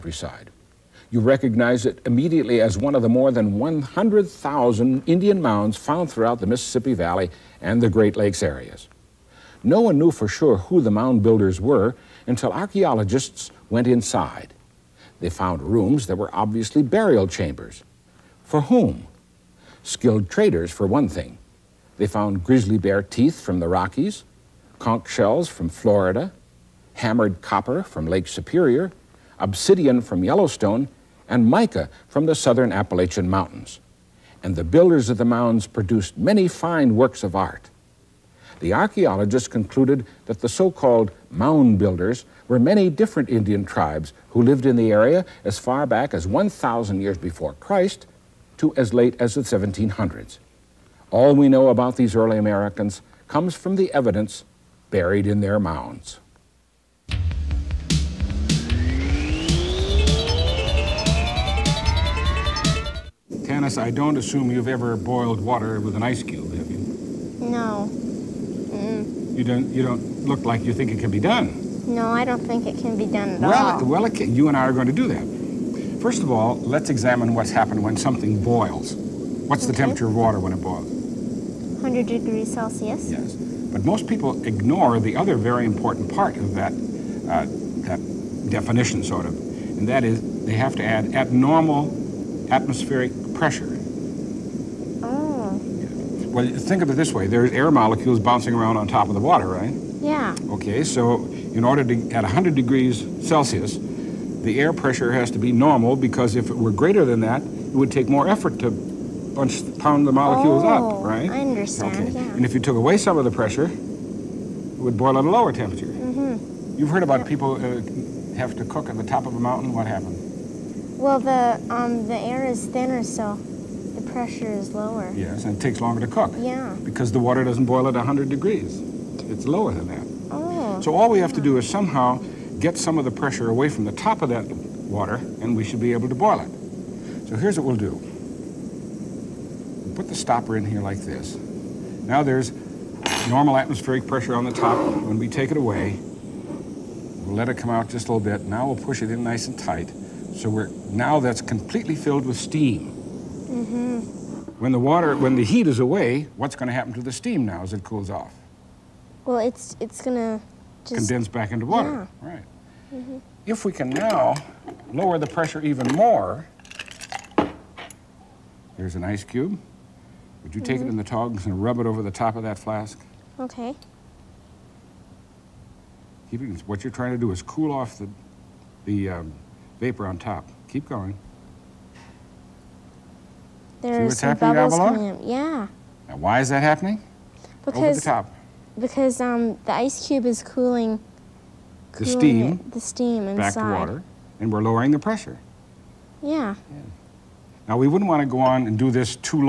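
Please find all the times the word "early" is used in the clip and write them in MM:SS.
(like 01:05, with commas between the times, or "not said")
00:52.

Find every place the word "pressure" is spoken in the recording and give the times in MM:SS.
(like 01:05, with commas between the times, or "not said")
01:33, 01:44, 01:53, 02:04, 02:13, 02:24, 02:45, 03:14.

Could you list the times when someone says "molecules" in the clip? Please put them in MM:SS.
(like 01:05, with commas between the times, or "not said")
01:37, 01:50.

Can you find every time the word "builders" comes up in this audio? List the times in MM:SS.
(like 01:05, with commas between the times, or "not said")
00:11, 00:34, 00:41.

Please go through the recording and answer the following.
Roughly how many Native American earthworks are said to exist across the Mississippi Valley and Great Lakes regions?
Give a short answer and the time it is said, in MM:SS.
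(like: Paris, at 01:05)
100,000, at 00:03.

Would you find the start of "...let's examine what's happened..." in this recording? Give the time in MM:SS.
01:16.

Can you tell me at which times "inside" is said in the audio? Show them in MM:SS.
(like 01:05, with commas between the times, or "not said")
00:13, 03:13.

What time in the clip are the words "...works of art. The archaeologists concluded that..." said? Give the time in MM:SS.
00:36.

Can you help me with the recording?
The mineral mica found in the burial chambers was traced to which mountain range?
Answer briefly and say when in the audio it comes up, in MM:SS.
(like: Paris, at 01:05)
southern Appalachian Mountains, at 00:32.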